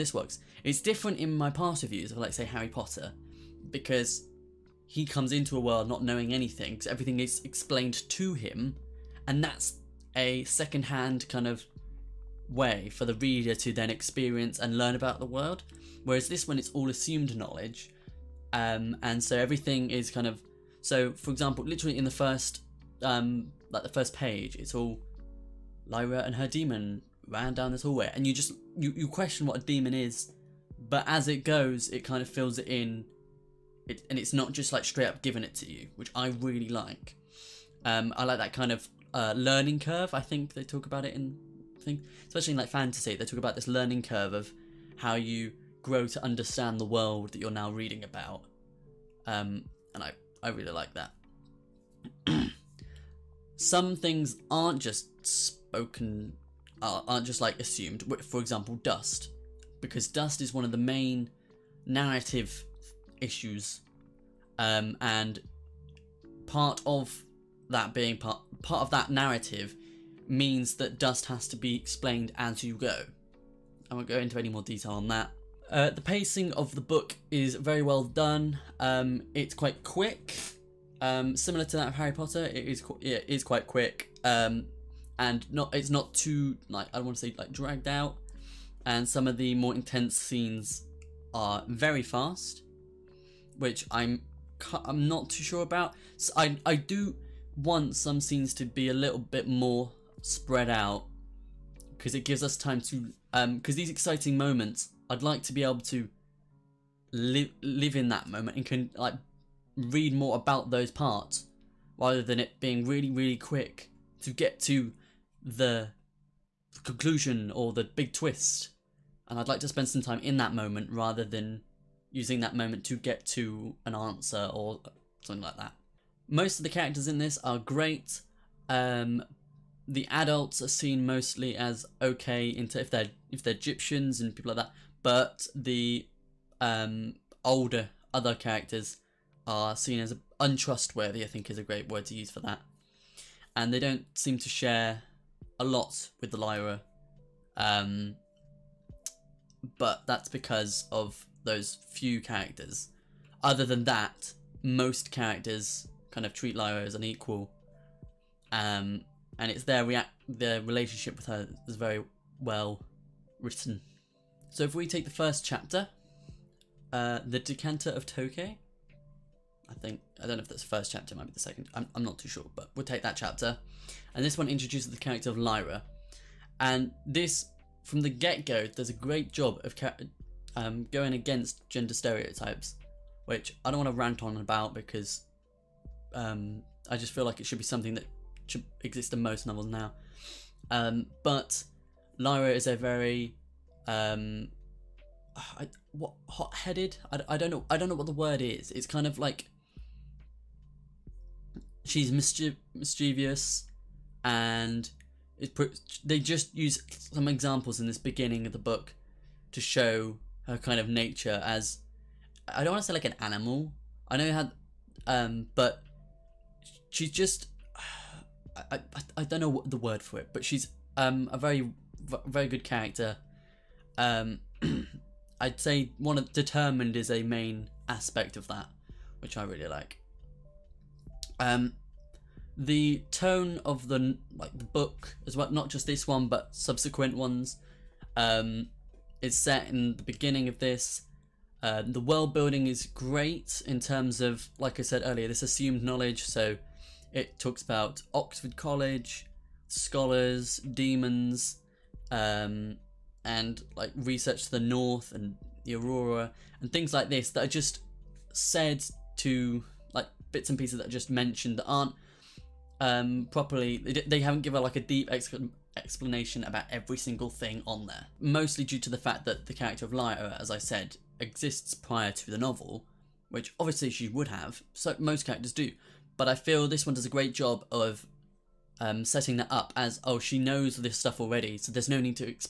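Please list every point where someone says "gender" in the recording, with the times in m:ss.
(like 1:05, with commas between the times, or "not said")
3:01.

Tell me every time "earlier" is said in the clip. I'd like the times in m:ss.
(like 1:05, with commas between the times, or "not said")
4:05.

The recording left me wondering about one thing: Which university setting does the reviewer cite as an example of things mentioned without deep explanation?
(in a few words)
Oxford College.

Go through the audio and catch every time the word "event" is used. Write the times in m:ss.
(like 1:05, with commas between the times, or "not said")
not said.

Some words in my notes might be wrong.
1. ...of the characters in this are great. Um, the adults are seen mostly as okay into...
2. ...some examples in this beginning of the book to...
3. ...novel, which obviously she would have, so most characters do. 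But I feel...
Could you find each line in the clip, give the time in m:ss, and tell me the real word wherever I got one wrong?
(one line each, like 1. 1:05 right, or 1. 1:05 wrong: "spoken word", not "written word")
1. 2:06 right
2. 3:27 right
3. 4:32 right.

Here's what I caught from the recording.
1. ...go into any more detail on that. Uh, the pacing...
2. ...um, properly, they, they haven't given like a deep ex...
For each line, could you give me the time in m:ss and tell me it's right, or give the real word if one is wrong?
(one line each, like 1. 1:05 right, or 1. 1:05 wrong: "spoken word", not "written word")
1. 1:14 right
2. 4:22 right.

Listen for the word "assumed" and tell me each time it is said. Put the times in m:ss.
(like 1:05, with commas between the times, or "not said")
0:16, 0:57, 4:05.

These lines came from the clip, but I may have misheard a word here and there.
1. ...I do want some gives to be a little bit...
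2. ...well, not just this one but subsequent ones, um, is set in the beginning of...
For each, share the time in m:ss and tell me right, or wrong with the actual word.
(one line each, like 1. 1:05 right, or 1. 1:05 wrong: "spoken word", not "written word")
1. 1:36 wrong: "scenes", not "gives"
2. 3:55 right.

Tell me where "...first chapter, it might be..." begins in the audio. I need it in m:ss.
2:50.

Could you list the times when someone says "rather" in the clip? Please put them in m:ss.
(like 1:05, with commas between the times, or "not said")
1:51, 2:00.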